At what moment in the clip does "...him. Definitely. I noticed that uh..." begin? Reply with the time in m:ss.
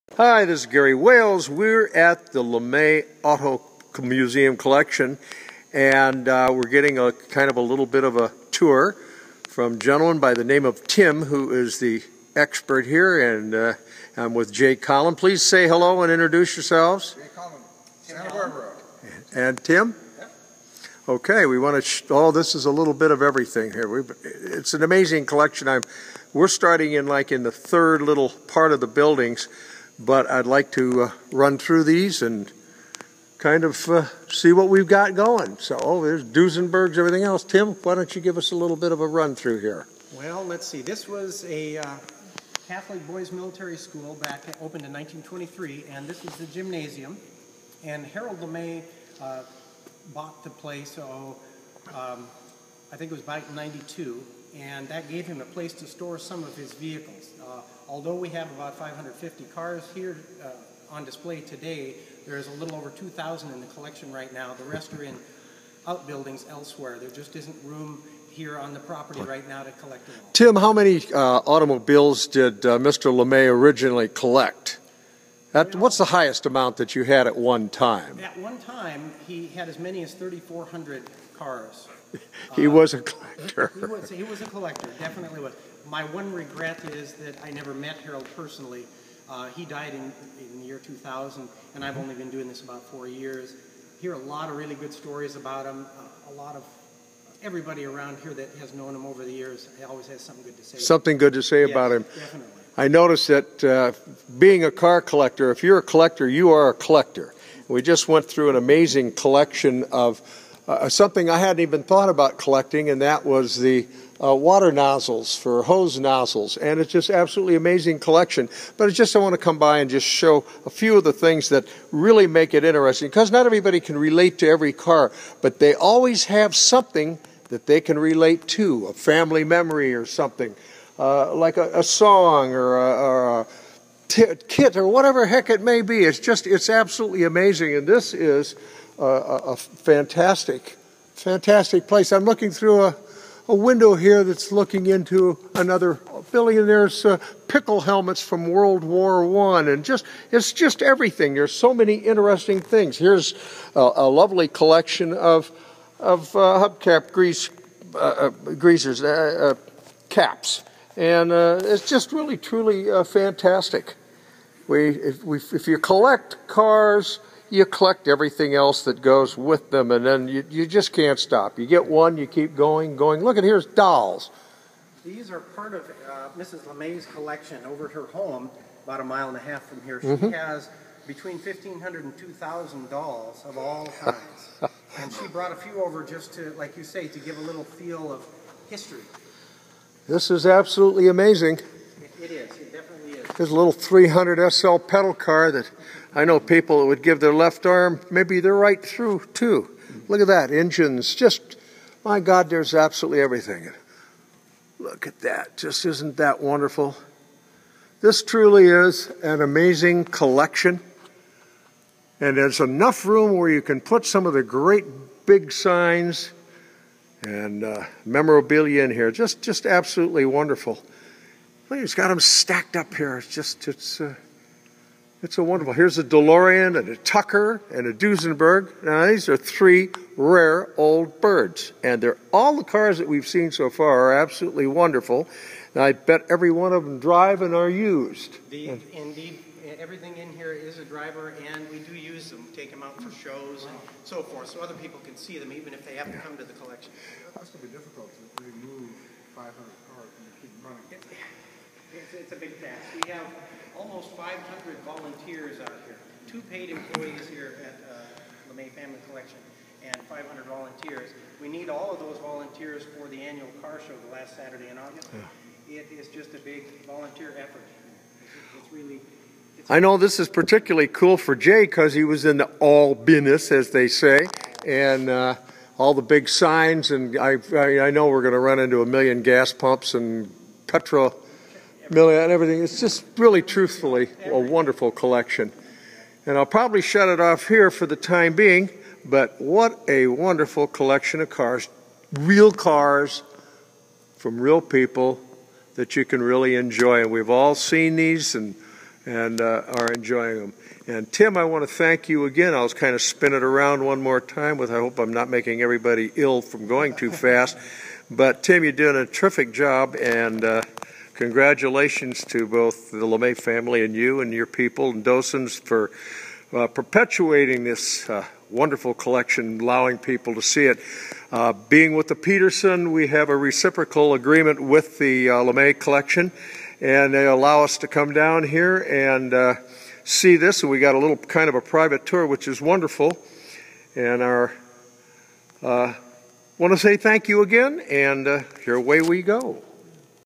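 1:41.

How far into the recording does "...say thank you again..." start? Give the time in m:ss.
5:36.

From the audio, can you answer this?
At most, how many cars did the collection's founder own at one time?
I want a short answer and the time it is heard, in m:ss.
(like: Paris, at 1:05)
3,400, at 1:20.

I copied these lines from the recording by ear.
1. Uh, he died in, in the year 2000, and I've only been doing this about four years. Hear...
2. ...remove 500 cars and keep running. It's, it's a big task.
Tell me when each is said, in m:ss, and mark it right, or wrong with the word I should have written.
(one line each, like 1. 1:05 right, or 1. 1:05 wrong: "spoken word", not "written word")
1. 1:29 right
2. 4:08 right.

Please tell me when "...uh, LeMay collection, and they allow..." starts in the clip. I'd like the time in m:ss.
5:25.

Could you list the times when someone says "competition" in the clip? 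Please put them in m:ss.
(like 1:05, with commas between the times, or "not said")
not said.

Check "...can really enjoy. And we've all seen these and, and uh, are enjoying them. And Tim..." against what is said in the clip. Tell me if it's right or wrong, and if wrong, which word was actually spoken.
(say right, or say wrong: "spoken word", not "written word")
right.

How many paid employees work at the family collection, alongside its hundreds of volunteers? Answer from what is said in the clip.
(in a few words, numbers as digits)
2.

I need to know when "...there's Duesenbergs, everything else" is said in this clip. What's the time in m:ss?
0:36.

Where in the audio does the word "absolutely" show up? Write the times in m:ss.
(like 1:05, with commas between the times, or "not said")
1:57, 2:16, 3:10, 3:22, 3:39, 3:54.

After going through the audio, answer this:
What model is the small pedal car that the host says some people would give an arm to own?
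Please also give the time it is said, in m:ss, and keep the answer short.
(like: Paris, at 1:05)
300 SL, at 3:13.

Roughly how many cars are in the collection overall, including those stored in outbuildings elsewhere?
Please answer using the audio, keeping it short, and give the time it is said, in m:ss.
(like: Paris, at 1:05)
Over 2,000, at 1:02.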